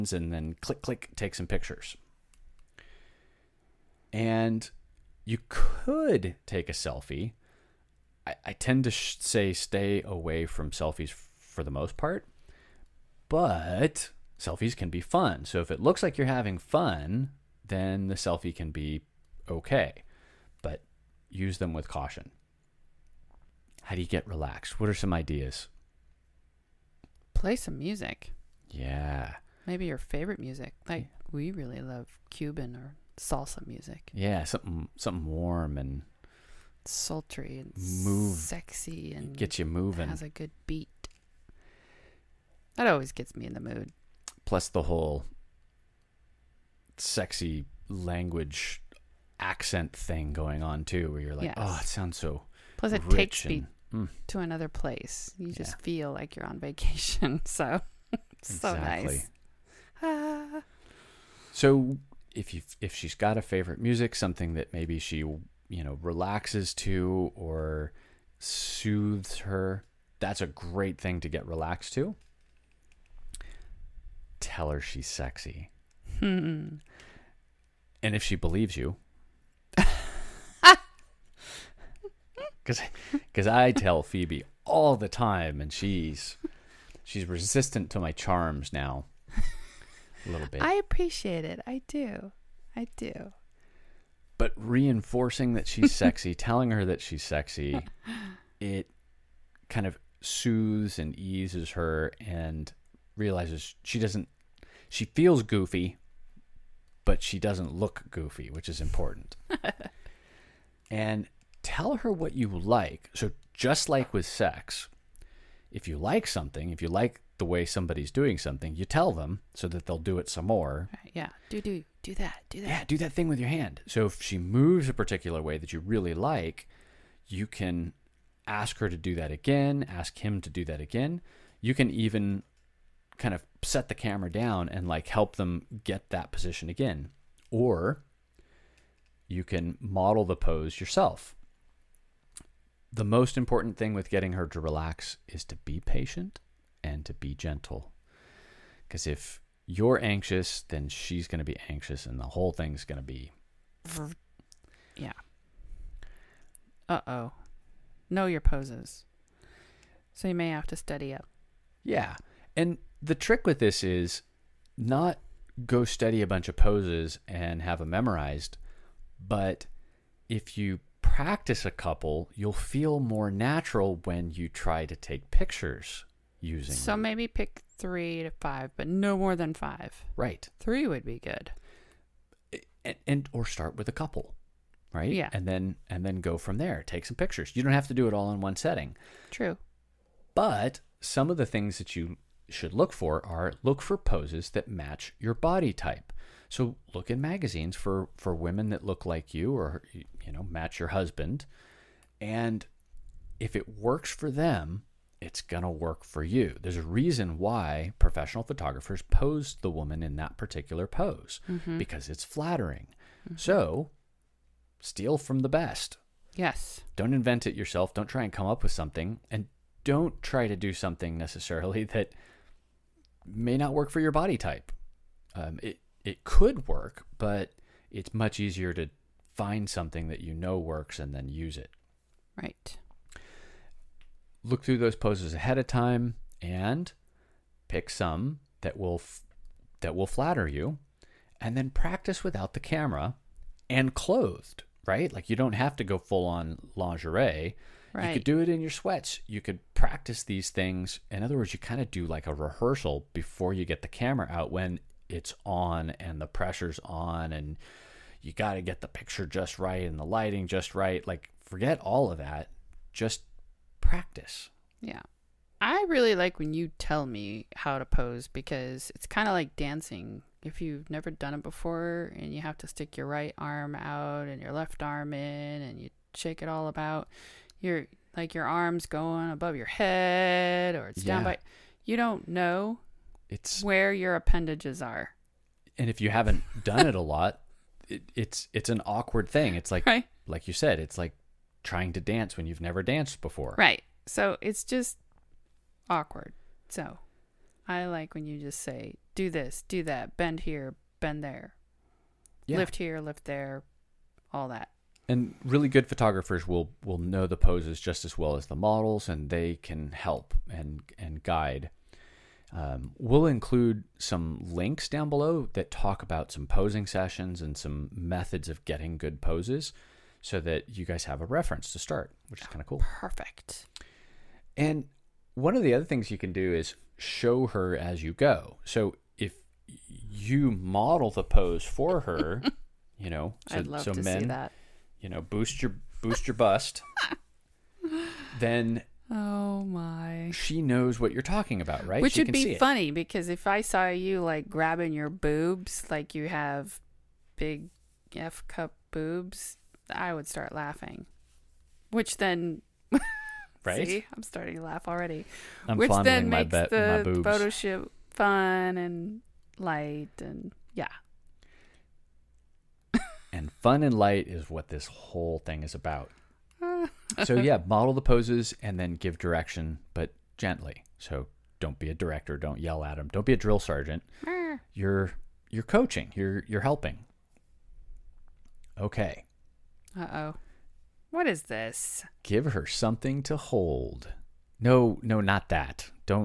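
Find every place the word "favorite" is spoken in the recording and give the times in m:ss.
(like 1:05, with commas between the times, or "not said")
0:29, 1:03.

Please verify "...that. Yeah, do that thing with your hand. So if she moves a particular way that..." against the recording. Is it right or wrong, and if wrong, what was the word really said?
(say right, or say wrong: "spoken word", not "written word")
right.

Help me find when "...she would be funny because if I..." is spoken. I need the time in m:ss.
5:42.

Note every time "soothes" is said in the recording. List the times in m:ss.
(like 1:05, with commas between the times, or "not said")
1:08, 1:40.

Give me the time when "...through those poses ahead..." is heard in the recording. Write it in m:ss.
3:54.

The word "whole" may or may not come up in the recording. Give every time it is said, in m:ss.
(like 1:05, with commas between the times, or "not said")
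0:44, 2:32, 6:04.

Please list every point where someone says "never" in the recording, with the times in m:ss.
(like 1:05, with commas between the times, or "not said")
4:30, 4:52.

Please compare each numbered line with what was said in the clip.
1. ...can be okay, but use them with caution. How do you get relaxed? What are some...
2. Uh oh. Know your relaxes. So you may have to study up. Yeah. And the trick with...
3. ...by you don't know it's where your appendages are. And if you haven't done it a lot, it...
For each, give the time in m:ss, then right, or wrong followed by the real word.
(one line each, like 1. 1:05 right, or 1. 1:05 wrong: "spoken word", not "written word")
1. 0:18 right
2. 2:36 wrong: "poses", not "relaxes"
3. 4:41 right.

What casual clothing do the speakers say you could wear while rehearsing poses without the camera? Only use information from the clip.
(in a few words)
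sweats.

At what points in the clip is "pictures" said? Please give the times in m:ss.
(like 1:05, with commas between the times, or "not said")
0:01, 2:55, 3:07, 4:18.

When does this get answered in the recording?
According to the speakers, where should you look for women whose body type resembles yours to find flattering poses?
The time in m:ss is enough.
3:17.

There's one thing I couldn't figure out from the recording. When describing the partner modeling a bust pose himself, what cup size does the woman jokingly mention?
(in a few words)
F cup.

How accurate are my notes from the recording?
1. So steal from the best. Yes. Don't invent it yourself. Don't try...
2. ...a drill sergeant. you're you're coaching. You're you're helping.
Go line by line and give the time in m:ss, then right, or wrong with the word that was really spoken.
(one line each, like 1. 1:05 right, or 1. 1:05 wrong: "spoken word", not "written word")
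1. 3:33 right
2. 6:13 right.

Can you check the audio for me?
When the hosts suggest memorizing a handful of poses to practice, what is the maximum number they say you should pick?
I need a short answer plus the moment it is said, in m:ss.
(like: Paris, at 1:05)
5, at 2:58.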